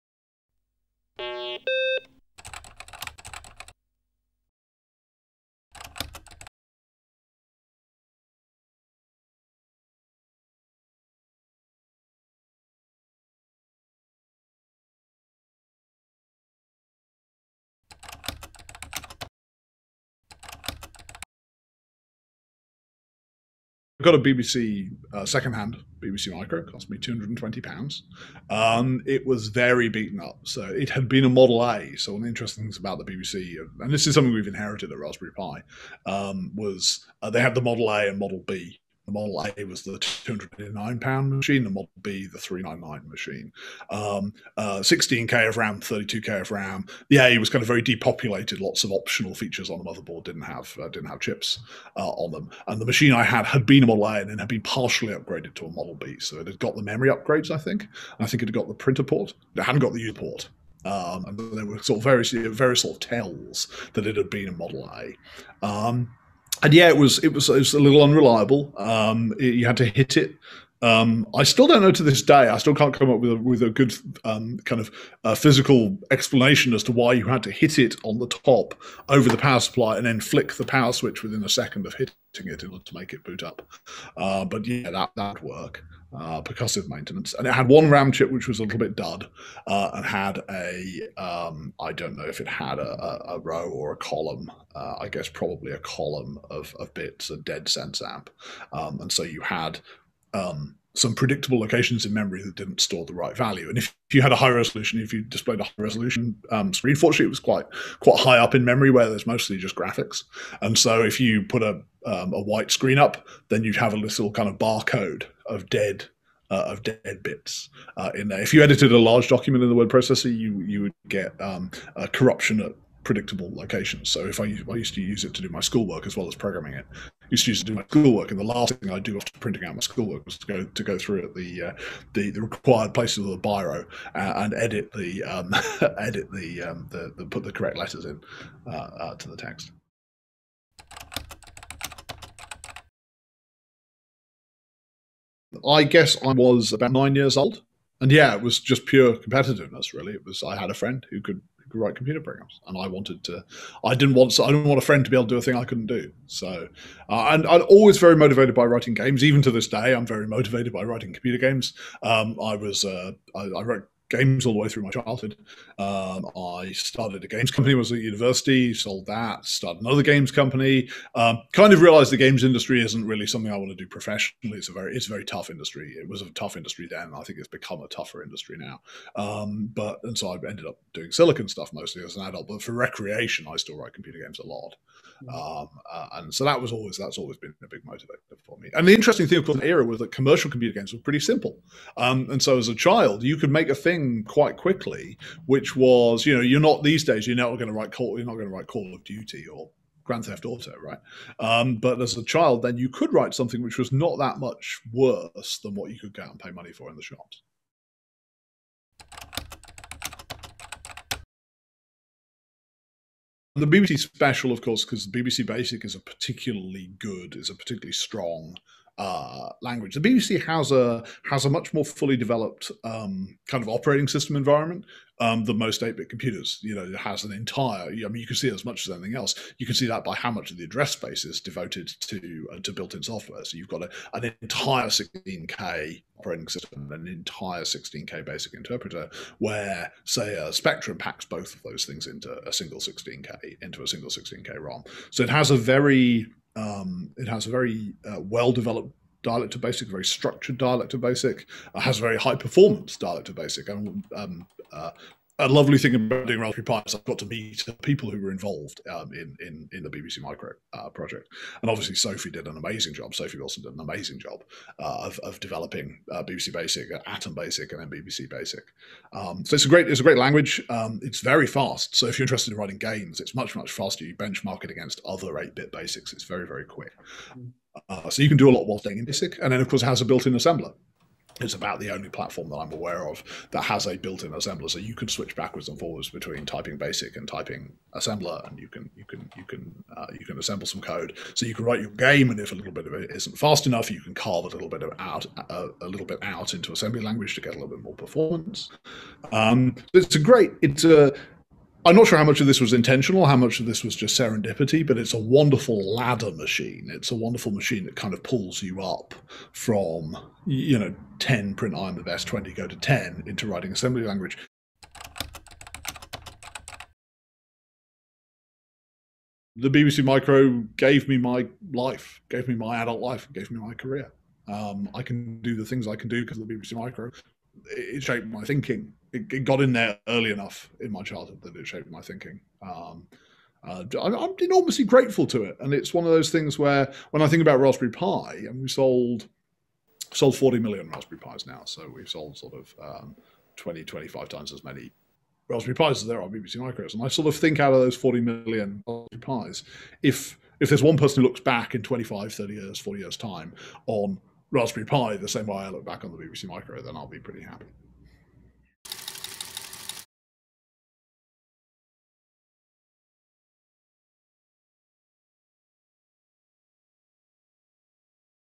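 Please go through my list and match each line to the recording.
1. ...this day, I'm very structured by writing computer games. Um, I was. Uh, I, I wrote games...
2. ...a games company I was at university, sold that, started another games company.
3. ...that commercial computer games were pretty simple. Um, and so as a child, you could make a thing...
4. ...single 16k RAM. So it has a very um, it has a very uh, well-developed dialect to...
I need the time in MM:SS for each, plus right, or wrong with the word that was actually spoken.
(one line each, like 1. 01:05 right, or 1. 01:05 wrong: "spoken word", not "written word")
1. 02:39 wrong: "motivated", not "structured"
2. 02:47 right
3. 03:09 right
4. 04:03 wrong: "ROM", not "RAM".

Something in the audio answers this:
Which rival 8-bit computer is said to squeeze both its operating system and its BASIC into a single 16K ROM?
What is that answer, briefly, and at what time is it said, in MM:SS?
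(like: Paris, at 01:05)
Spectrum, at 04:00.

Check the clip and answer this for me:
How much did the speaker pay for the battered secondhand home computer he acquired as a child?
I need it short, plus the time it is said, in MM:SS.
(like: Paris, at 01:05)
£220, at 00:26.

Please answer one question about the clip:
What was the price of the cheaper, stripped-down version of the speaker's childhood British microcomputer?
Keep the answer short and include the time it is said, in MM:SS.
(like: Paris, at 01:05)
£209, at 00:39.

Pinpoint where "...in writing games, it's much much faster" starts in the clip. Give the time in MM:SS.
04:32.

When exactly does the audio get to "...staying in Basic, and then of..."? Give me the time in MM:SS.
04:38.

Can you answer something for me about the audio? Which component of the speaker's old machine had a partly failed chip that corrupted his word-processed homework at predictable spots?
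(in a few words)
RAM chip.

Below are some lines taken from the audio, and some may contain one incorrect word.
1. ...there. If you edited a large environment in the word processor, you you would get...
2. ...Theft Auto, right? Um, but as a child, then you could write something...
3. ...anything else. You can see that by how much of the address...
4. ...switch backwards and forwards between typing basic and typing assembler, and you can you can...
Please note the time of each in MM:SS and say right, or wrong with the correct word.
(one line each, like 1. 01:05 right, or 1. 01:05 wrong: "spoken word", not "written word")
1. 01:58 wrong: "document", not "environment"
2. 03:20 right
3. 03:48 right
4. 04:45 right.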